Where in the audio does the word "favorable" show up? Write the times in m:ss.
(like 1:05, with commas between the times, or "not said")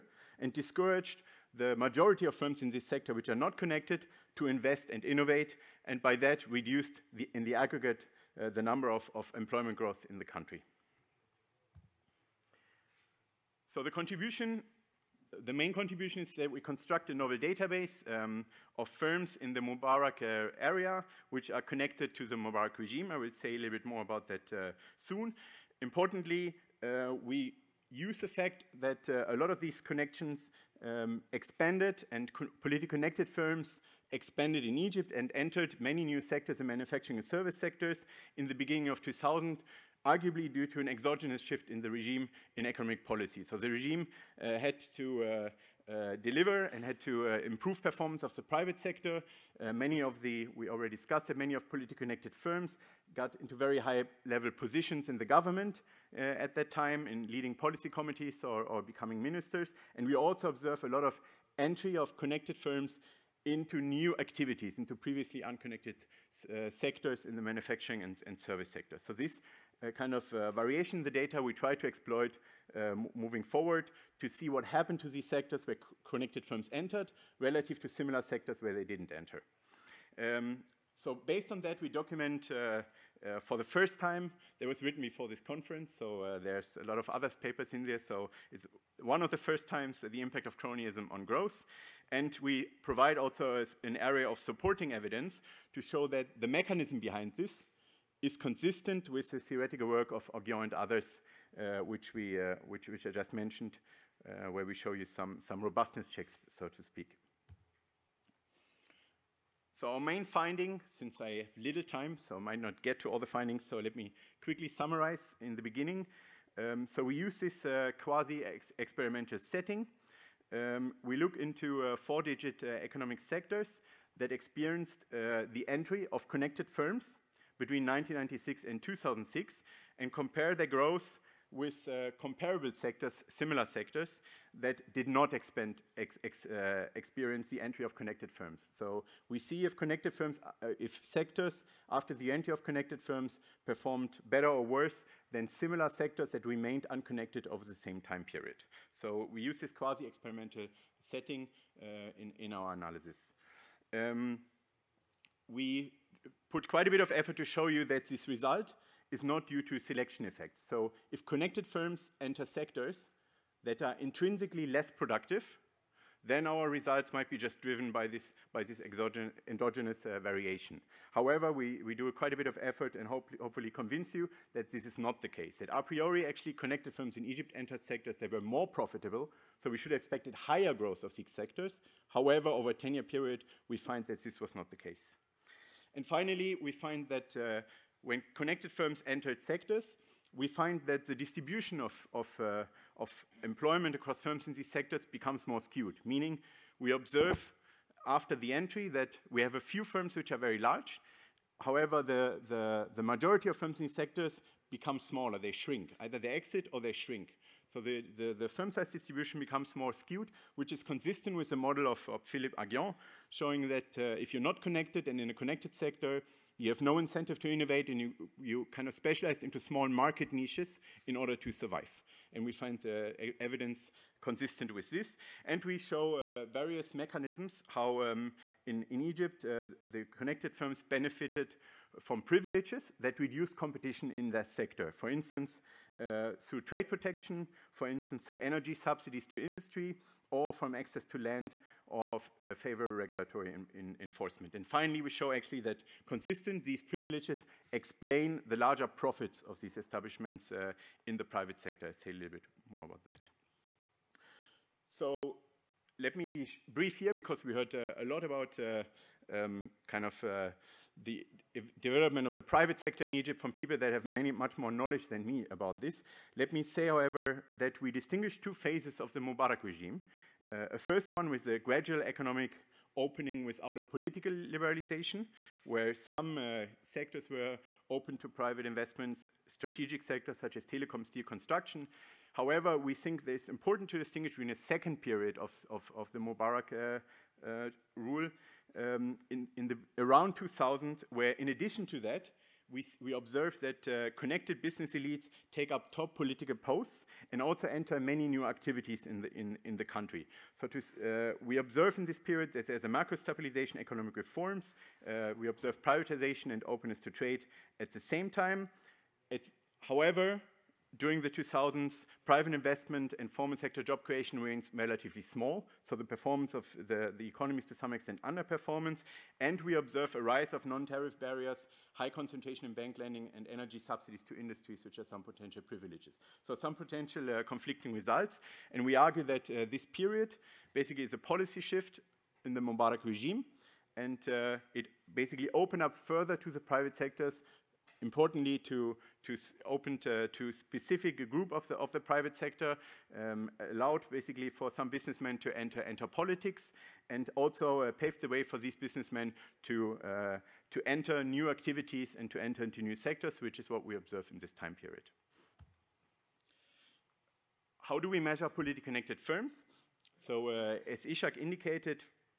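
4:02.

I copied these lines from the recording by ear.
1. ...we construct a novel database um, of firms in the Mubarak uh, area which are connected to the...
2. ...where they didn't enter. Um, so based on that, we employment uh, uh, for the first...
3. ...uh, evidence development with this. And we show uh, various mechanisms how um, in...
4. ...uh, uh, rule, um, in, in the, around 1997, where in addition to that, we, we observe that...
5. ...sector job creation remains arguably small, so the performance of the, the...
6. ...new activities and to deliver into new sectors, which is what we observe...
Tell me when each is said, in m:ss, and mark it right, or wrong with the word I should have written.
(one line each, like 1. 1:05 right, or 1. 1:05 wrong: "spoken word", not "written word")
1. 0:16 right
2. 1:18 wrong: "document", not "employment"
3. 3:43 wrong: "consistent", not "development"
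4. 4:46 wrong: "2000", not "1997"
5. 5:13 wrong: "relatively", not "arguably"
6. 5:51 wrong: "enter", not "deliver".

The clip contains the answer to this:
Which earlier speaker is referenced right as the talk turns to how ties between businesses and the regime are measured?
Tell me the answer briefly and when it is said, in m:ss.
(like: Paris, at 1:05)
Ishac, at 6:01.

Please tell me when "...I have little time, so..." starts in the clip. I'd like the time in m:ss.
1:51.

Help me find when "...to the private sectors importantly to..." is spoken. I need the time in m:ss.
5:36.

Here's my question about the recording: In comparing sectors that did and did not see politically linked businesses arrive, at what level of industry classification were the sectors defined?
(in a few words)
four-digit.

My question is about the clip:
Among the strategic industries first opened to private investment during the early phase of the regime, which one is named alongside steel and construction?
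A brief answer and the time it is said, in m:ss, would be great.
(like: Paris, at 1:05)
telecom, at 4:40.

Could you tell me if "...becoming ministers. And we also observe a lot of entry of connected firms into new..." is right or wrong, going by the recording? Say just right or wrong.
right.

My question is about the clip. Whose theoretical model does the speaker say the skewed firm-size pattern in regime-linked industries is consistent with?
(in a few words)
Philippe Aghion.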